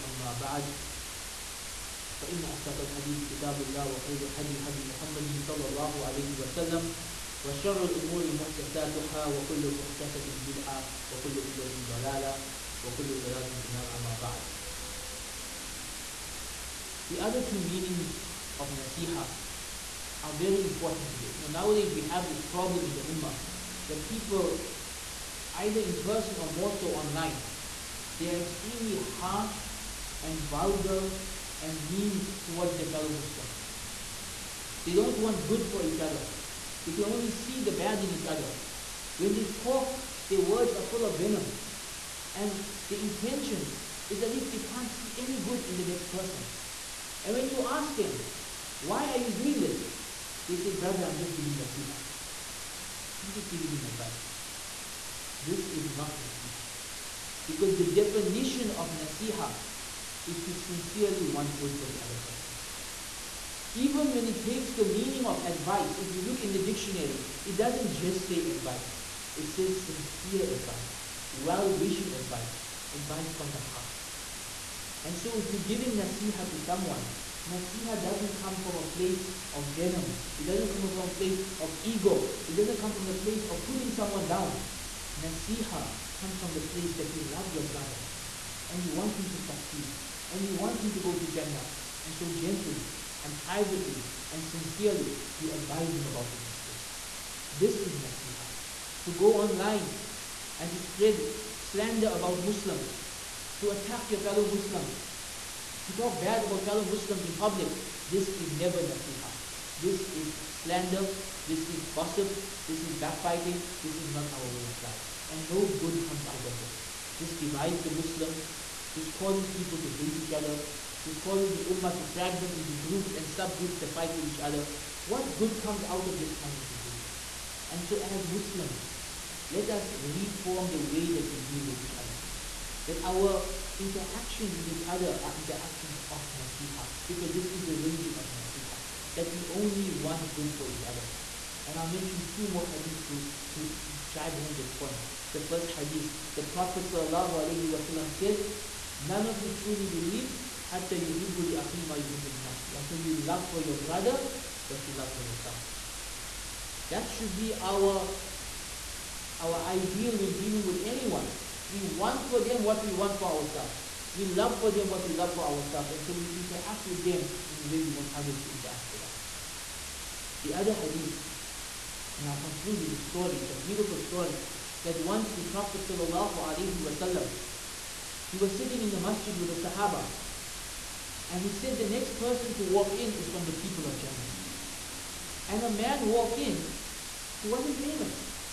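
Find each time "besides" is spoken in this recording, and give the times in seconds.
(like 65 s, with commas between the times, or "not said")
not said.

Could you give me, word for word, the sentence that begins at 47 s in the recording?
And when you ask them, why are you doing this?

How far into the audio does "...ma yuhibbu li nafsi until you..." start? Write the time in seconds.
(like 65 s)
151 s.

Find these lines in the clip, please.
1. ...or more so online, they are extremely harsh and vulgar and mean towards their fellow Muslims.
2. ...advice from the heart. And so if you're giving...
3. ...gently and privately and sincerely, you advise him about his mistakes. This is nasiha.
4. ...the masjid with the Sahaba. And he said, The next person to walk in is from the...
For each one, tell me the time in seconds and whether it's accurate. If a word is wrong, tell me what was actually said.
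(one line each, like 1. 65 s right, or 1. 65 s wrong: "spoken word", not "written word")
1. 26 s right
2. 72 s right
3. 92 s right
4. 178 s right.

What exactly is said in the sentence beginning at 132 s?
That our interactions with each other are interactions of nasiha, because this is the religion of nasiha.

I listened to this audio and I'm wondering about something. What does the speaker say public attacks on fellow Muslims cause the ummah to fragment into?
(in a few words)
groups and subgroups.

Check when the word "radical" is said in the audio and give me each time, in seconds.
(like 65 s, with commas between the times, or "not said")
not said.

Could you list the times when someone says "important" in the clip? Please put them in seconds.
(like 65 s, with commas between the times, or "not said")
20 s.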